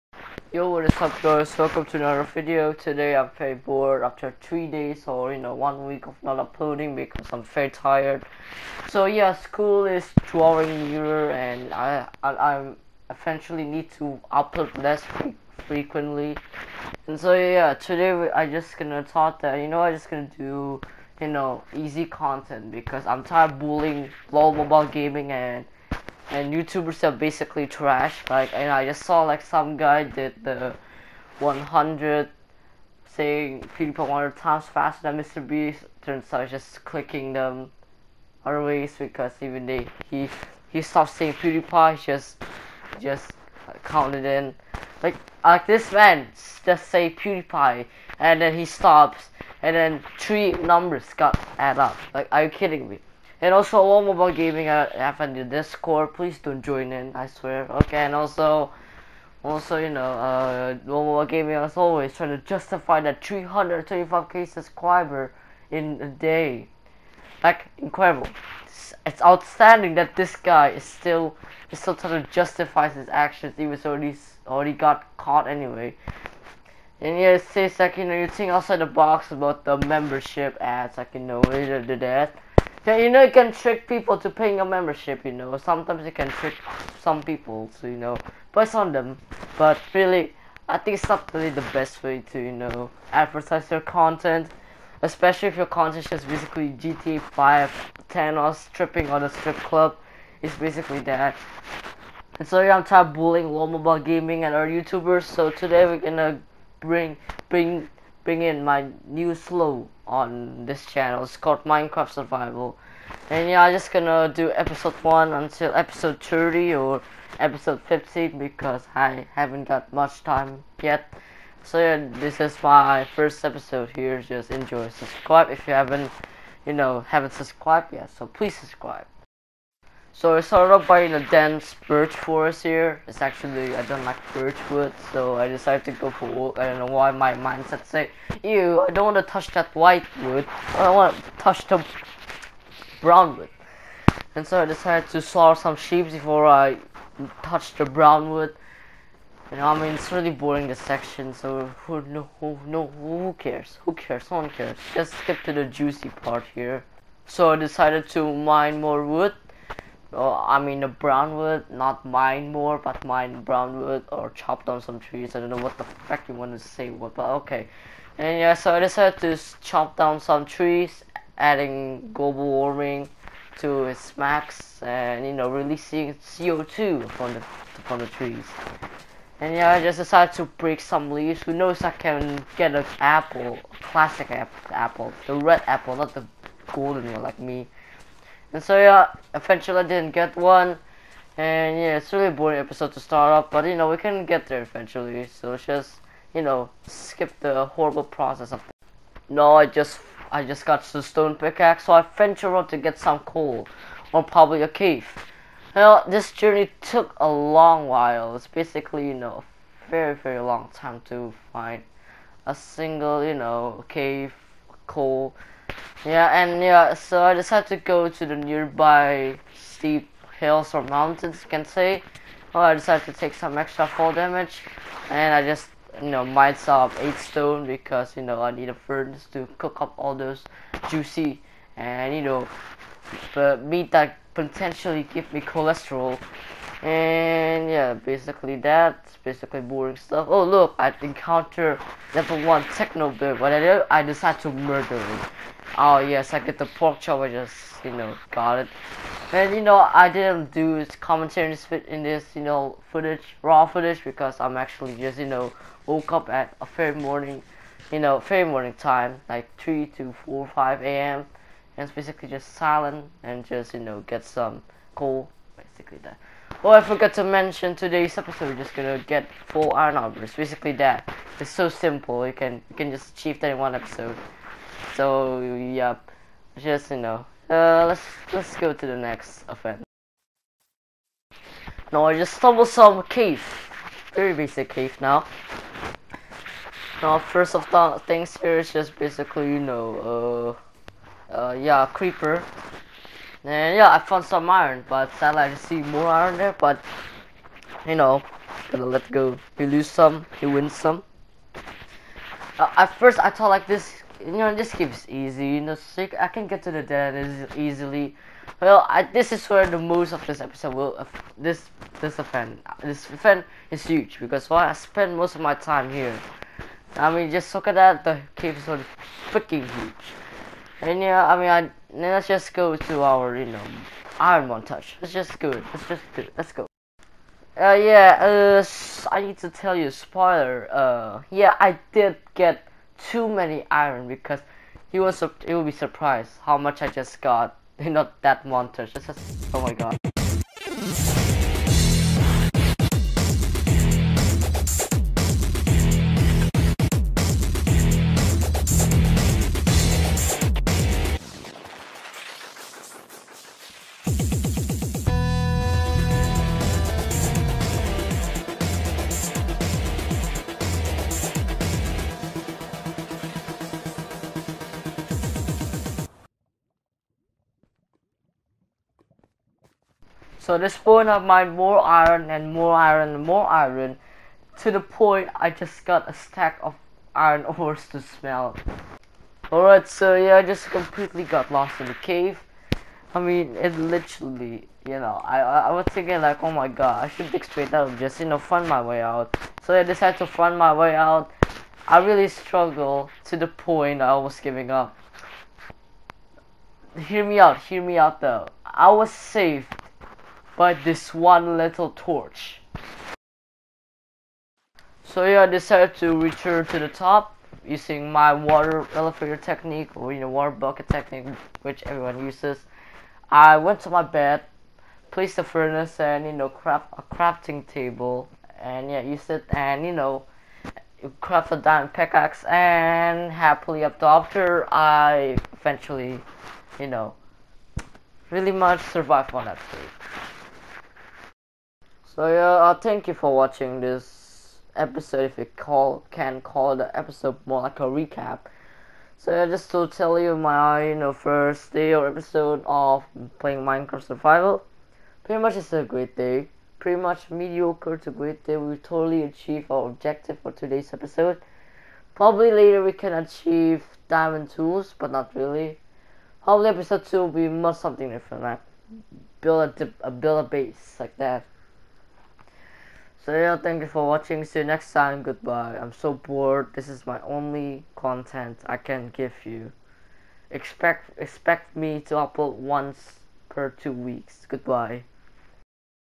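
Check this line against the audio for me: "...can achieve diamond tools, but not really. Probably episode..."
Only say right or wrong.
right.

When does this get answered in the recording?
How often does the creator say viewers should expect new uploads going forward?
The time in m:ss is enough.
7:52.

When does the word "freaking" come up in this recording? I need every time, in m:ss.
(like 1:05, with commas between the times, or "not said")
5:19.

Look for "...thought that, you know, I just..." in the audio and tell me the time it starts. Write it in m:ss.
0:19.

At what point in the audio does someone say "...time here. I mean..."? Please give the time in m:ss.
5:15.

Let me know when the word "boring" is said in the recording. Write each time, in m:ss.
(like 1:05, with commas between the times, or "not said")
2:30, 3:12, 3:59.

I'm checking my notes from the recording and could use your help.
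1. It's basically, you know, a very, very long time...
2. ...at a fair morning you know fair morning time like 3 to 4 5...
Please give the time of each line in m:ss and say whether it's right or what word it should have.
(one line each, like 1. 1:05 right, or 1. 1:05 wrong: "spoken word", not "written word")
1. 3:28 right
2. 4:16 right.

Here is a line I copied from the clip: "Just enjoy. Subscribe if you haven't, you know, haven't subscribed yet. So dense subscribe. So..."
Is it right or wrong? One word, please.
wrong.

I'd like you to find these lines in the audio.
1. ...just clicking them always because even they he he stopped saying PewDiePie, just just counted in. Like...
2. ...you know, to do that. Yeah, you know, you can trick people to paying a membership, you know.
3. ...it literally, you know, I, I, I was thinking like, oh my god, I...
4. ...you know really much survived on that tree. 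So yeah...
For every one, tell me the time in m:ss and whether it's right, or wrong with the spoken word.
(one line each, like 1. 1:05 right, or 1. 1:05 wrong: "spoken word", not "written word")
1. 0:36 right
2. 1:21 right
3. 6:23 right
4. 7:06 right.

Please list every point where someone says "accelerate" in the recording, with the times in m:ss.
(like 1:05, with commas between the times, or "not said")
not said.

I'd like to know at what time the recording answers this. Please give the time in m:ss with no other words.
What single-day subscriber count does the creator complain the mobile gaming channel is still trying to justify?
1:03.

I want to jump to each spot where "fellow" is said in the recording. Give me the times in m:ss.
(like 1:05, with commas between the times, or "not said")
not said.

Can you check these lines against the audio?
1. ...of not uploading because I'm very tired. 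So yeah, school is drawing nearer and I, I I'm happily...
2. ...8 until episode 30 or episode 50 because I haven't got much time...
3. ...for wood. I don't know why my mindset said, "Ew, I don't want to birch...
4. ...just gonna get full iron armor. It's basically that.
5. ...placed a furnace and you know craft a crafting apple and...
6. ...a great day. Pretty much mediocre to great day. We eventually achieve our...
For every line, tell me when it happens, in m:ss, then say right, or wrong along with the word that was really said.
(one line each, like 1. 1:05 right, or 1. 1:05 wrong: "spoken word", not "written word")
1. 0:06 wrong: "eventually", not "happily"
2. 1:54 wrong: "1", not "8"
3. 2:16 wrong: "touch", not "birch"
4. 4:28 right
5. 6:55 wrong: "table", not "apple"
6. 7:25 wrong: "totally", not "eventually".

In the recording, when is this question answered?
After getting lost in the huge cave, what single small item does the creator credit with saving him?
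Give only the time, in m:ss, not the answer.
6:41.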